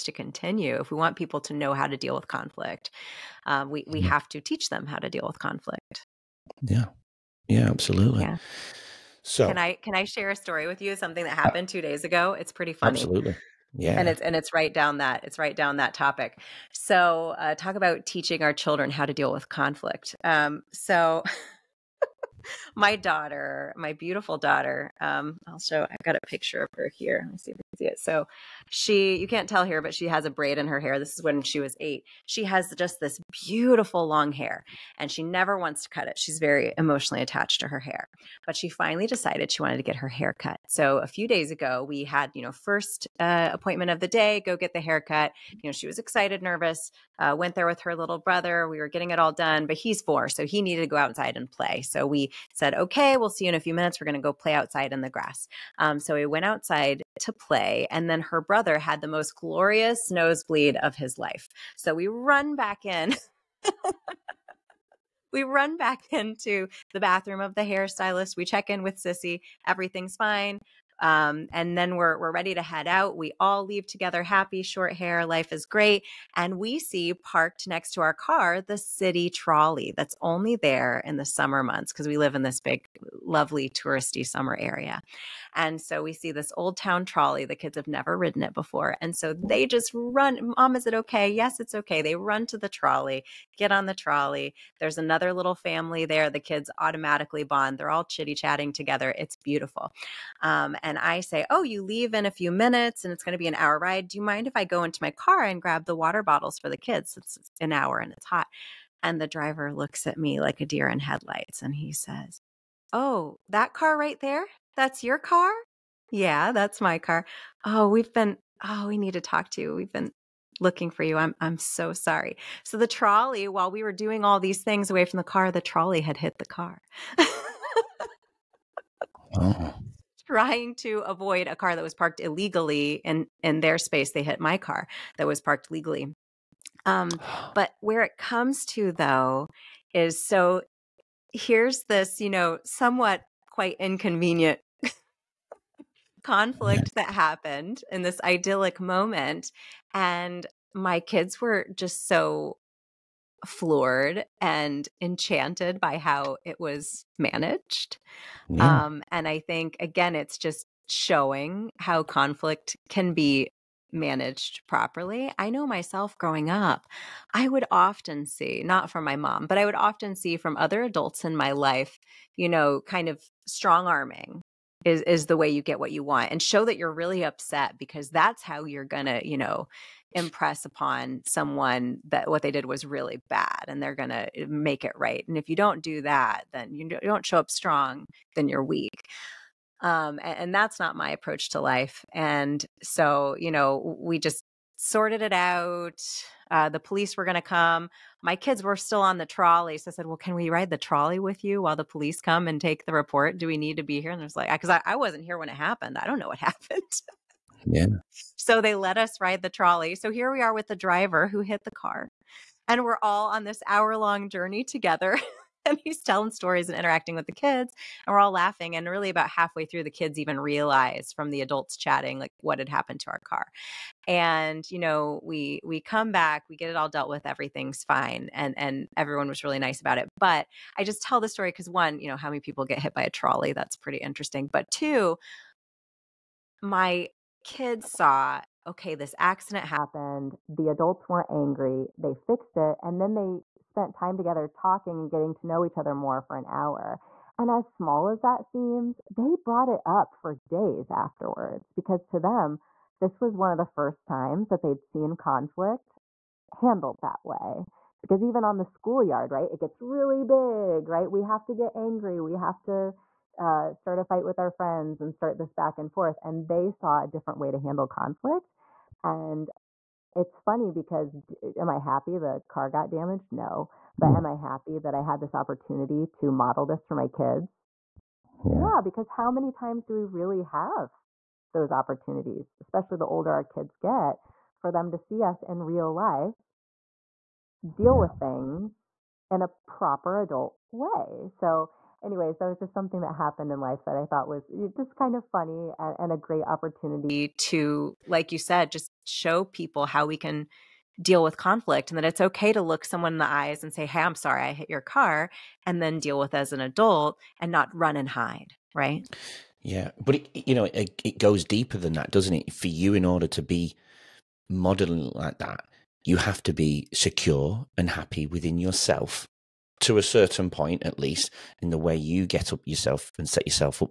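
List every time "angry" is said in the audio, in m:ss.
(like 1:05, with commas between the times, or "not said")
4:01, 4:21.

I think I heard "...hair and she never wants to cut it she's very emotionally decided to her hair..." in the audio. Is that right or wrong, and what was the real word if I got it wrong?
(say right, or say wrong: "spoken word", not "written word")
wrong: "attached", not "decided".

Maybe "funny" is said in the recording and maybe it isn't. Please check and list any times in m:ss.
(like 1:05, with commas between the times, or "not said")
0:12, 4:30, 4:55.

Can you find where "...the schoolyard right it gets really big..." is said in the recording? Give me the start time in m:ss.
4:18.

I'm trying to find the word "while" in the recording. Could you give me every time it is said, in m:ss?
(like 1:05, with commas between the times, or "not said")
2:03, 3:21.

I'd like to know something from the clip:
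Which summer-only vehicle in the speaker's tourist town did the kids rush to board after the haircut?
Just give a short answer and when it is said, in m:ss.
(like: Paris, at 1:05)
old town trolley, at 1:26.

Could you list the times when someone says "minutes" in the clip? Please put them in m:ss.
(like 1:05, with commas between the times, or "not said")
0:53, 1:42.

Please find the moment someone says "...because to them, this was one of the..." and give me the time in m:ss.
4:11.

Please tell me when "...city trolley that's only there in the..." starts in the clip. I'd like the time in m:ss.
1:18.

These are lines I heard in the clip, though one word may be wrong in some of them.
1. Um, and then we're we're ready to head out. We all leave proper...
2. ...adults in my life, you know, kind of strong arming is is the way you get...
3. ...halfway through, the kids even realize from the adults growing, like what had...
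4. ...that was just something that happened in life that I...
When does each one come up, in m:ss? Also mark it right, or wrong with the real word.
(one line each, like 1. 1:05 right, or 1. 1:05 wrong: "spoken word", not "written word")
1. 1:11 wrong: "together", not "proper"
2. 2:50 right
3. 3:39 wrong: "chatting", not "growing"
4. 4:52 right.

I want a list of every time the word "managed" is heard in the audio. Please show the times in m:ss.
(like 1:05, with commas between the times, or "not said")
2:37, 2:43.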